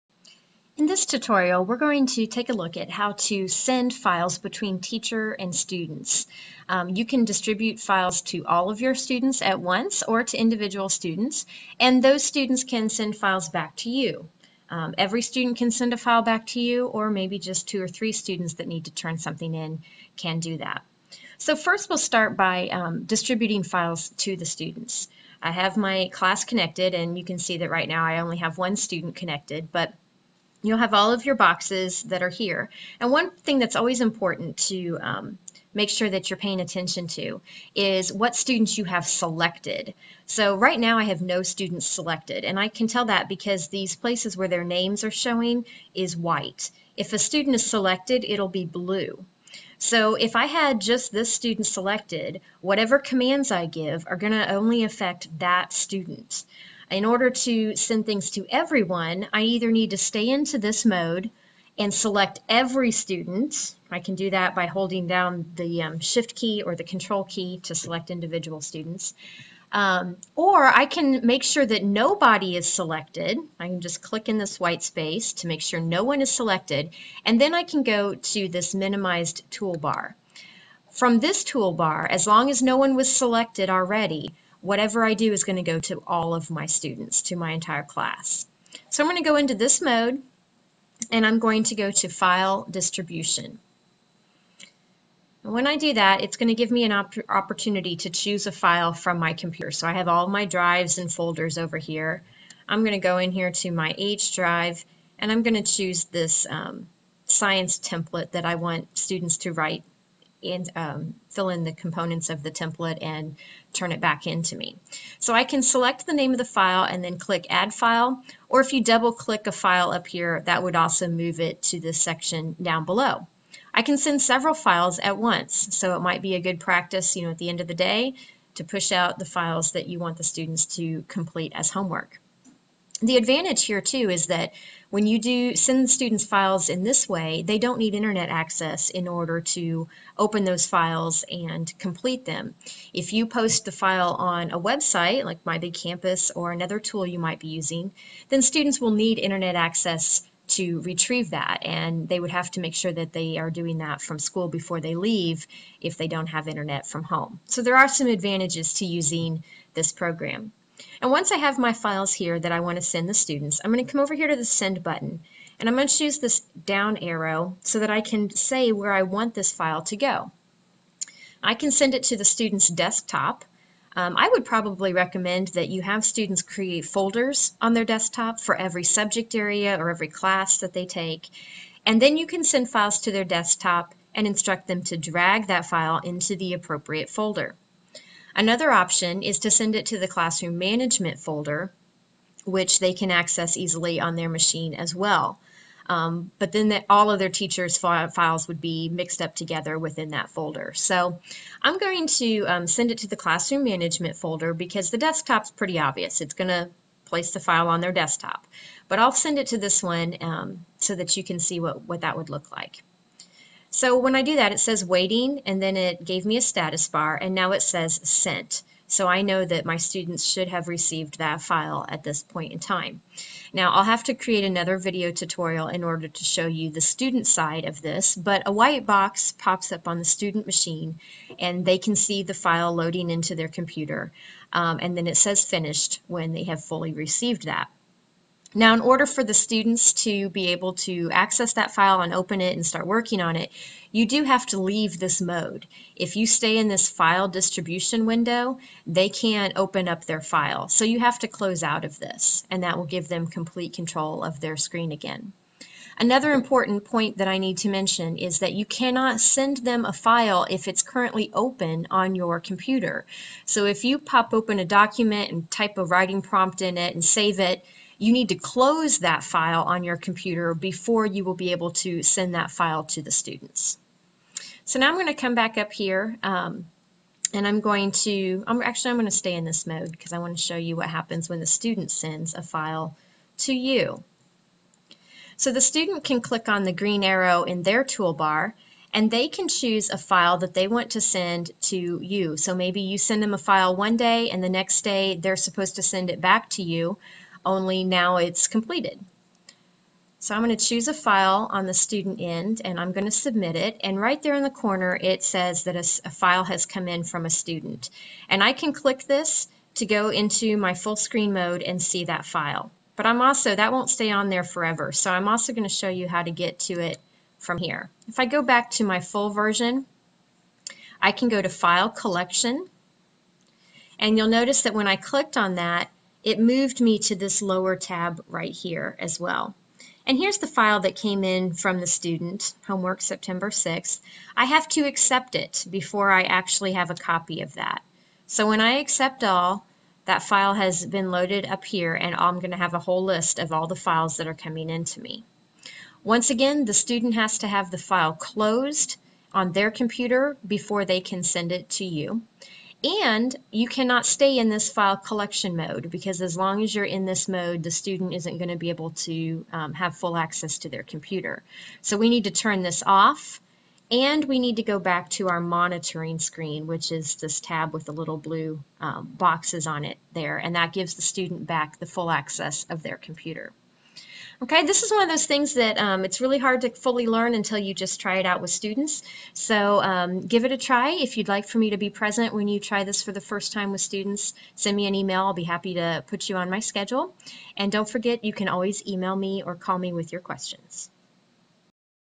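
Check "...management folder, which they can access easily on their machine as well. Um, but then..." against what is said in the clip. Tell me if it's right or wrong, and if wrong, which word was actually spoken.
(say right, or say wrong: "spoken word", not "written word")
right.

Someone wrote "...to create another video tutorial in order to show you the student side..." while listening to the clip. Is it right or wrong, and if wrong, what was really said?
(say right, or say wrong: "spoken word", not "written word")
right.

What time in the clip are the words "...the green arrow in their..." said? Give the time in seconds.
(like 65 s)
286 s.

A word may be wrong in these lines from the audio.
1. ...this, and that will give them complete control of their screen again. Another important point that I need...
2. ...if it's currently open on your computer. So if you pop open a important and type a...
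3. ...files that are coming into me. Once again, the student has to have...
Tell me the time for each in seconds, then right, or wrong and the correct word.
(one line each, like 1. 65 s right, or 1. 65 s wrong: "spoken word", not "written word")
1. 251 s right
2. 260 s wrong: "document", not "important"
3. 343 s right.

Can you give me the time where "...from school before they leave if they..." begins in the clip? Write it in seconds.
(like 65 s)
154 s.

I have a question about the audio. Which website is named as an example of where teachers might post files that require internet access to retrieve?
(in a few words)
My Big Campus.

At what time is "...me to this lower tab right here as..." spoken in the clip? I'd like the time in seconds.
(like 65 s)
326 s.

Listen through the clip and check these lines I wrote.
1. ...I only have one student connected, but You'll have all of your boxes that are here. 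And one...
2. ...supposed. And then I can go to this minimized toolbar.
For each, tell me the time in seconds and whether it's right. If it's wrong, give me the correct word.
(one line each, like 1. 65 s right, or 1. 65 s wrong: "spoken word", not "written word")
1. 28 s right
2. 76 s wrong: "selected", not "supposed".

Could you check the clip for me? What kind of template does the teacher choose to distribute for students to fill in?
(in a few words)
Science template.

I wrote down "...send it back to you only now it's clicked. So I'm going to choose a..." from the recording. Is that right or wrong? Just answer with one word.
wrong.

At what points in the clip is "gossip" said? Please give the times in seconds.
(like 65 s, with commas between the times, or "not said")
not said.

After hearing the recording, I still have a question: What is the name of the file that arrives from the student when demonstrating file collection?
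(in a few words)
Homework September 6th.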